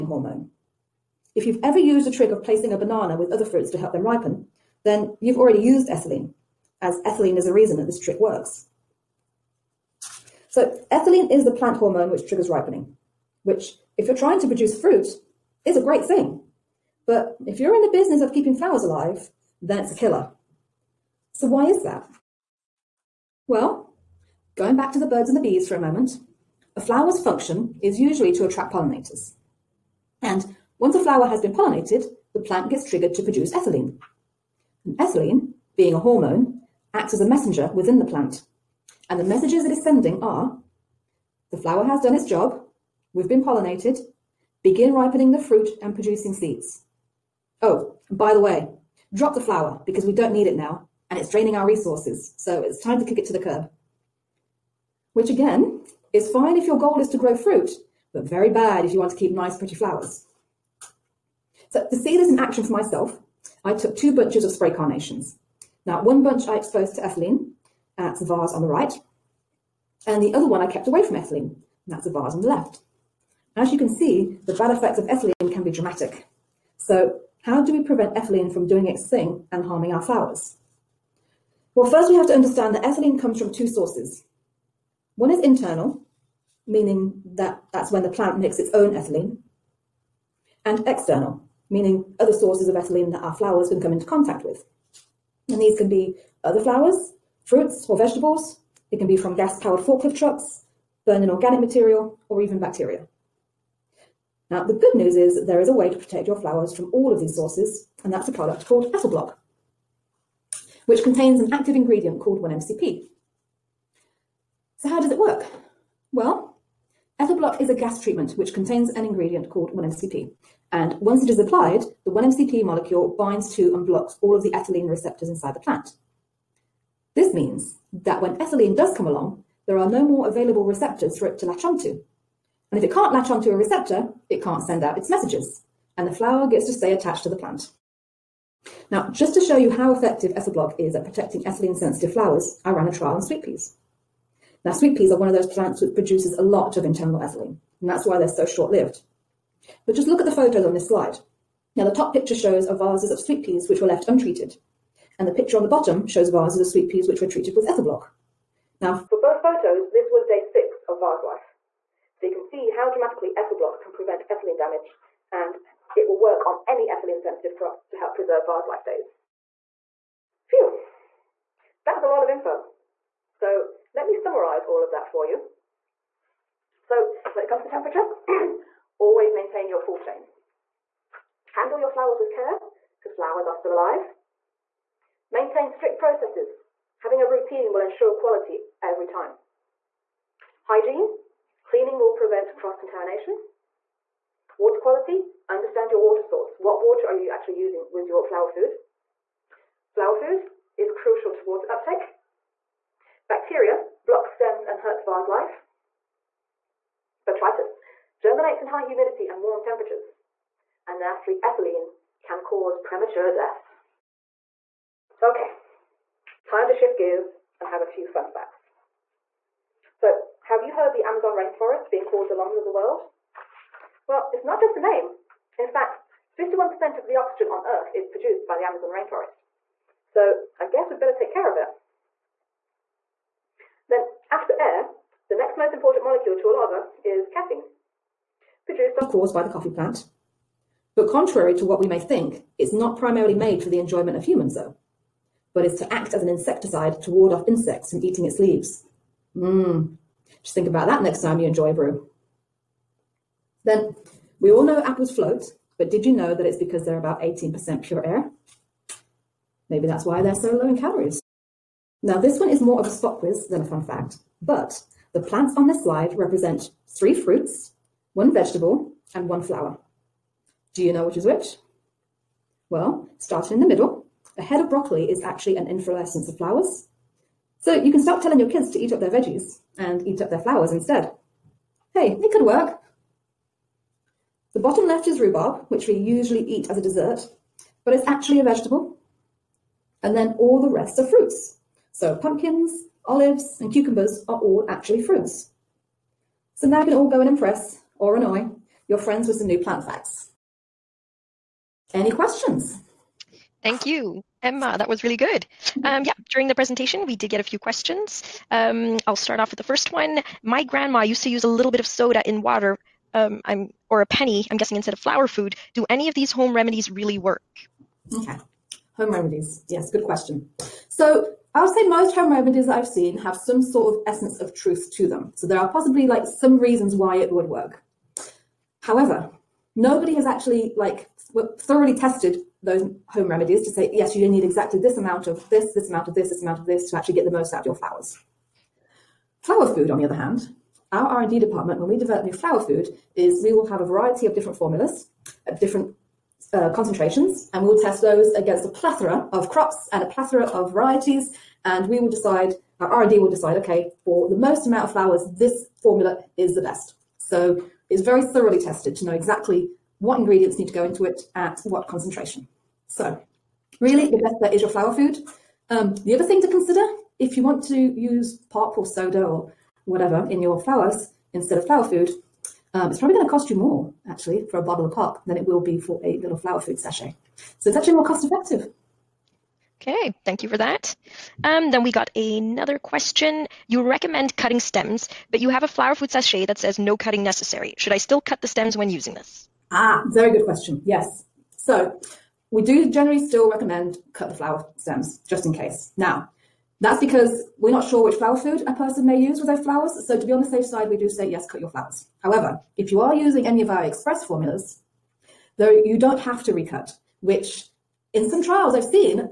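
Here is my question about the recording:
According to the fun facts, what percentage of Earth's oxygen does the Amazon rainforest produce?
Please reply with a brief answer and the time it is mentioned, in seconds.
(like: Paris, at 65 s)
51%, at 226 s.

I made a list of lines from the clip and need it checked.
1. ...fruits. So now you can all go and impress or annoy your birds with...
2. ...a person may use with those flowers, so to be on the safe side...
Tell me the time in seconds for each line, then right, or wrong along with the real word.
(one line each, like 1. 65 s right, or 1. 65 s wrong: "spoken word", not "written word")
1. 295 s wrong: "friends", not "birds"
2. 398 s right.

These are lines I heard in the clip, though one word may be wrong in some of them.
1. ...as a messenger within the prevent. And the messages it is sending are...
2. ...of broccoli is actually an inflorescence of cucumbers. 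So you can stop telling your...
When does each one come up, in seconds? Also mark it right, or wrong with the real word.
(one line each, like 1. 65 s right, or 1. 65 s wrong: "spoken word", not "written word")
1. 37 s wrong: "plant", not "prevent"
2. 274 s wrong: "flowers", not "cucumbers".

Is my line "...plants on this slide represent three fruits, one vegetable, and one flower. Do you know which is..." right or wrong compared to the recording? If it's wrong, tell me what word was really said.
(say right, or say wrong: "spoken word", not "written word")
right.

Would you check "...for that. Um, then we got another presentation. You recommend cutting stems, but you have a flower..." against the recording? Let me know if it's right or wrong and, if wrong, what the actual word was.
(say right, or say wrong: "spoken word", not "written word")
wrong: "question", not "presentation".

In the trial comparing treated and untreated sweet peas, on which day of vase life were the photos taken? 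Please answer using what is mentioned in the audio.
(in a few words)
6.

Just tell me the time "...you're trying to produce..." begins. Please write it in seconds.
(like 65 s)
14 s.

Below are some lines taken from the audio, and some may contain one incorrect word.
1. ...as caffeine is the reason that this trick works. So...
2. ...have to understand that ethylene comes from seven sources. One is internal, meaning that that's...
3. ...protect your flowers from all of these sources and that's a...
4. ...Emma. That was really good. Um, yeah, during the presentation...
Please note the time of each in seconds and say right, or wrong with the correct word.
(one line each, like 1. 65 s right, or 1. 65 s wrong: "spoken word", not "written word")
1. 6 s wrong: "ethylene", not "caffeine"
2. 82 s wrong: "two", not "seven"
3. 105 s right
4. 304 s right.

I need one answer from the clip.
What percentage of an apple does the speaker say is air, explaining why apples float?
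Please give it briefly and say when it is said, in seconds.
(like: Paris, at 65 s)
18%, at 257 s.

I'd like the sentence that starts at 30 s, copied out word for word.
And once a flower has been pollinated, the plant gets triggered to produce ethylene.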